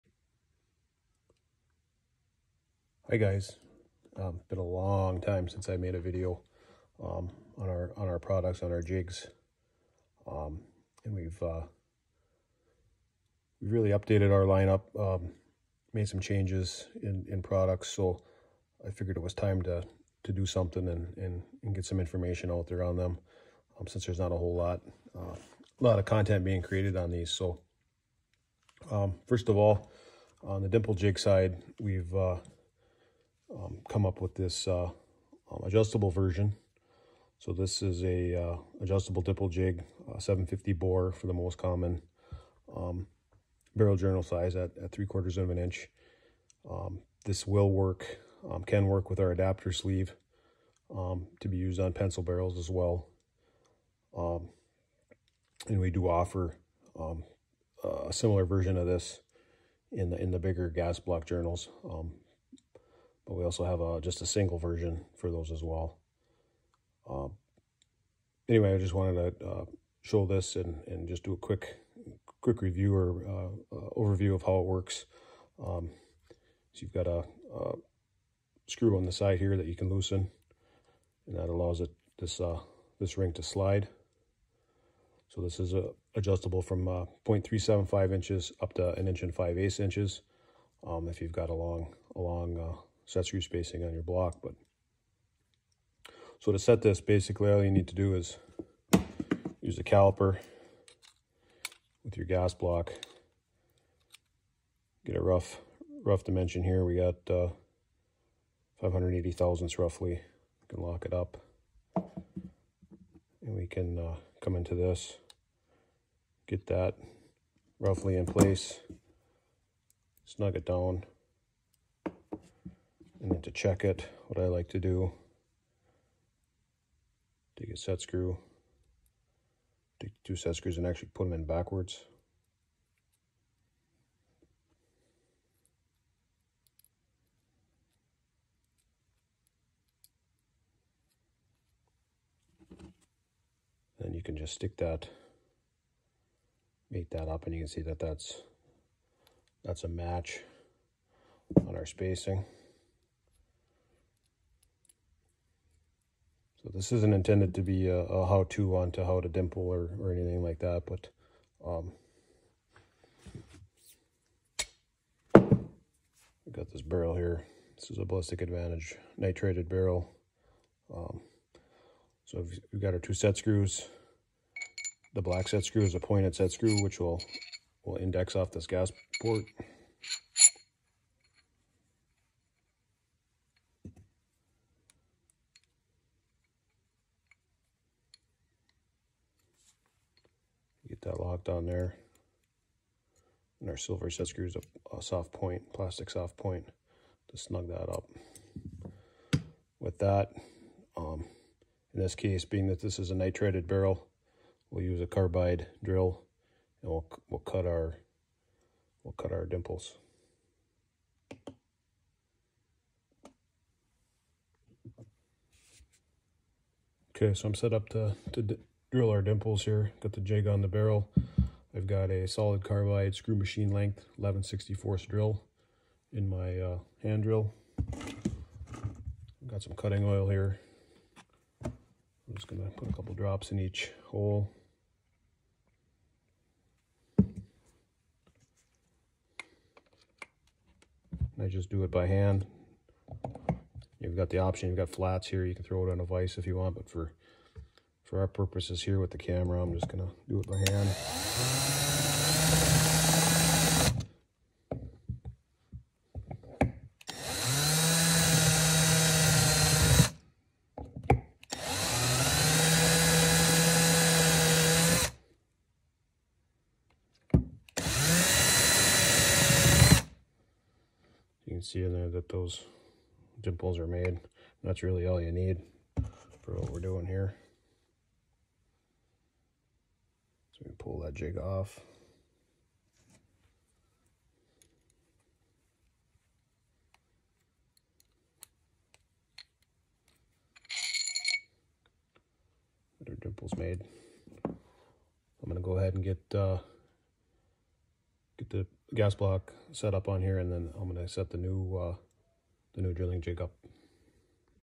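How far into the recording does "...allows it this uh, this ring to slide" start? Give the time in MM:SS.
01:21.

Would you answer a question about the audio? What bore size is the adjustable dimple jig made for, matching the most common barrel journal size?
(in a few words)
0.750.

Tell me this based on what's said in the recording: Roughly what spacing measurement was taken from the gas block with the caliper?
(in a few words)
580 thousandths.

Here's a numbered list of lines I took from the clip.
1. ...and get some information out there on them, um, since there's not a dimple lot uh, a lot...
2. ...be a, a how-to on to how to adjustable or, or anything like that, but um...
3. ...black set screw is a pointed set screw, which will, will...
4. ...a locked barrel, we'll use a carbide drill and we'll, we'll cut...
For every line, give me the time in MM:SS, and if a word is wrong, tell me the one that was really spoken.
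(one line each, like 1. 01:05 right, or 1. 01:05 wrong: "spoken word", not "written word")
1. 00:21 wrong: "whole", not "dimple"
2. 02:37 wrong: "dimple", not "adjustable"
3. 02:55 right
4. 03:23 wrong: "nitrated", not "locked".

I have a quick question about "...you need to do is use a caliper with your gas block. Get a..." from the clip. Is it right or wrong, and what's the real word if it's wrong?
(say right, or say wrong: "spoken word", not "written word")
right.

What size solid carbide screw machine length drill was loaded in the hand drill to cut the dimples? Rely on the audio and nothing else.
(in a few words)
11/64.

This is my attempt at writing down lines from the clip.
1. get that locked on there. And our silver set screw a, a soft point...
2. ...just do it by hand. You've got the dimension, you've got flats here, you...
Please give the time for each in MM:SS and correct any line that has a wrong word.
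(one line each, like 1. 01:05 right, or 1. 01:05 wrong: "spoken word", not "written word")
1. 03:11 right
2. 04:01 wrong: "option", not "dimension".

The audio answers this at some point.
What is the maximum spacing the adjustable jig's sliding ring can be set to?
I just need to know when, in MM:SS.
01:28.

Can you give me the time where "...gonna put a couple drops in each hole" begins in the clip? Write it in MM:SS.
03:52.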